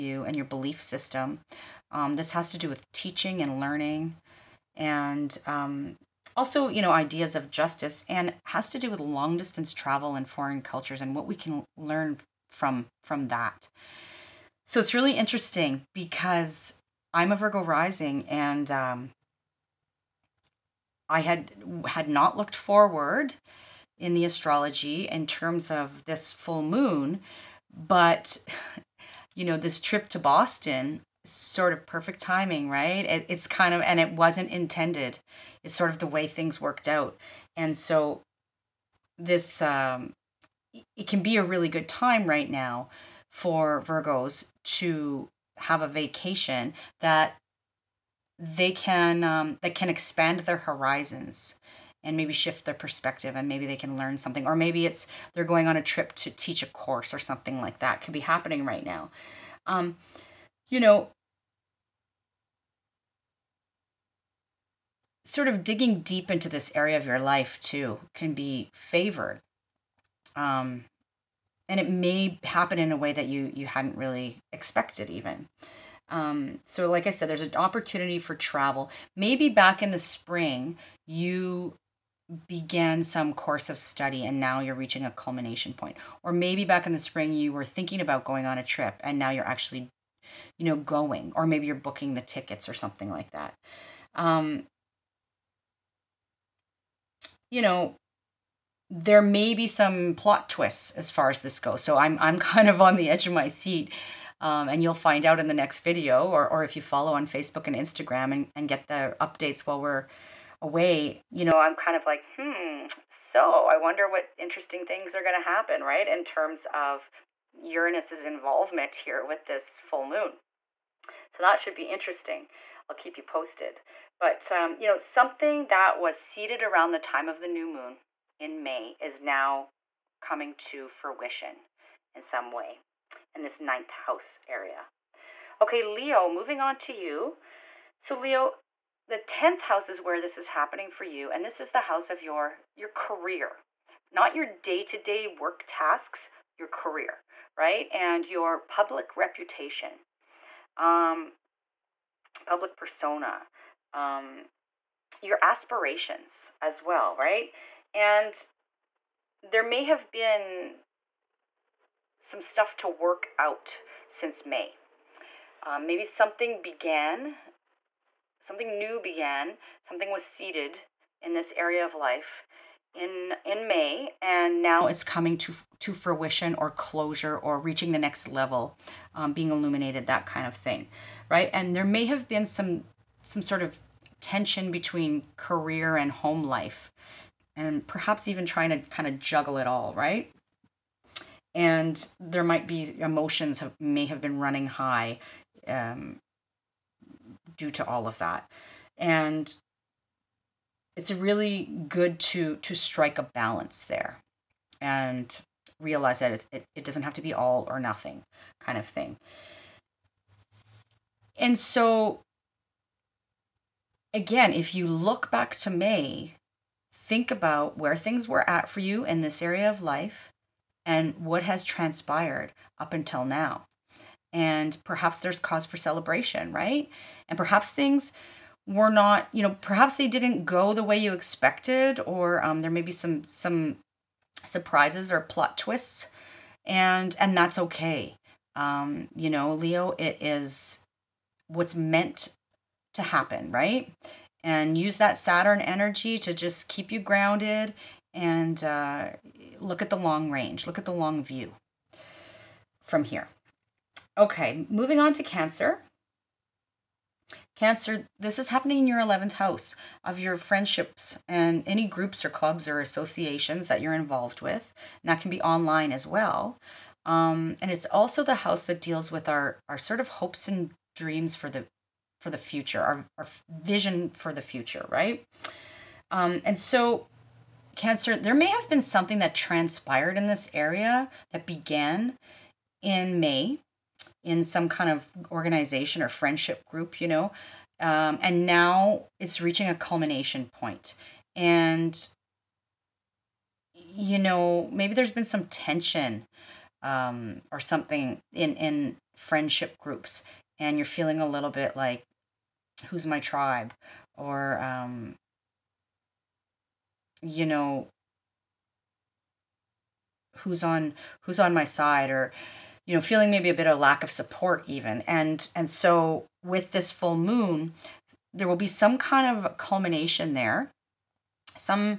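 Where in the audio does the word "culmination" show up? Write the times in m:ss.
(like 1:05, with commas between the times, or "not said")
1:25, 4:49, 5:19.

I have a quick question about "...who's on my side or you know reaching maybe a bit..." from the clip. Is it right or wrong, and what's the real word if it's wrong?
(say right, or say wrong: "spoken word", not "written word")
wrong: "feeling", not "reaching".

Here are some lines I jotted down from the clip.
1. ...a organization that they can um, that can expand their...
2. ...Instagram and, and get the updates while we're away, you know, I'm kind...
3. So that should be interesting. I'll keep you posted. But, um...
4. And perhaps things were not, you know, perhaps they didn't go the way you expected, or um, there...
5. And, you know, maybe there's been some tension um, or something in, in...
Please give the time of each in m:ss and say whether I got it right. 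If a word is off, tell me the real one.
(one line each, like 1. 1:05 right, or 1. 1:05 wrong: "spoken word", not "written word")
1. 0:45 wrong: "vacation", not "organization"
2. 1:47 right
3. 2:01 right
4. 3:47 right
5. 4:51 right.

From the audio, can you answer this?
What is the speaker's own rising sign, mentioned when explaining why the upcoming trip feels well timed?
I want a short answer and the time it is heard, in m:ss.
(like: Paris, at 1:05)
Virgo, at 0:17.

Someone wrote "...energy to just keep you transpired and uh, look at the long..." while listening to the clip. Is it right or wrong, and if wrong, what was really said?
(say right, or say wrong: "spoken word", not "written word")
wrong: "grounded", not "transpired".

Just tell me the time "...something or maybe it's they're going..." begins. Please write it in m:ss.
0:54.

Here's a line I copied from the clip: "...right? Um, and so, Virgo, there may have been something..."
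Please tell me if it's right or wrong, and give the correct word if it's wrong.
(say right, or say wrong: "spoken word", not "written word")
wrong: "Cancer", not "Virgo".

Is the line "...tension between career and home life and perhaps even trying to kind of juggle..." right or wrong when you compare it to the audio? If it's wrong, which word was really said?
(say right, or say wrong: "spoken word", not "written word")
right.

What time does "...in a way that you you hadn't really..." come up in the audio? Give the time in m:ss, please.
1:12.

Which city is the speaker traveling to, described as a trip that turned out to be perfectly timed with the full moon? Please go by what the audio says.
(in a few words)
Boston.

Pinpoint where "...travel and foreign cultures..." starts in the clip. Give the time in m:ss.
0:09.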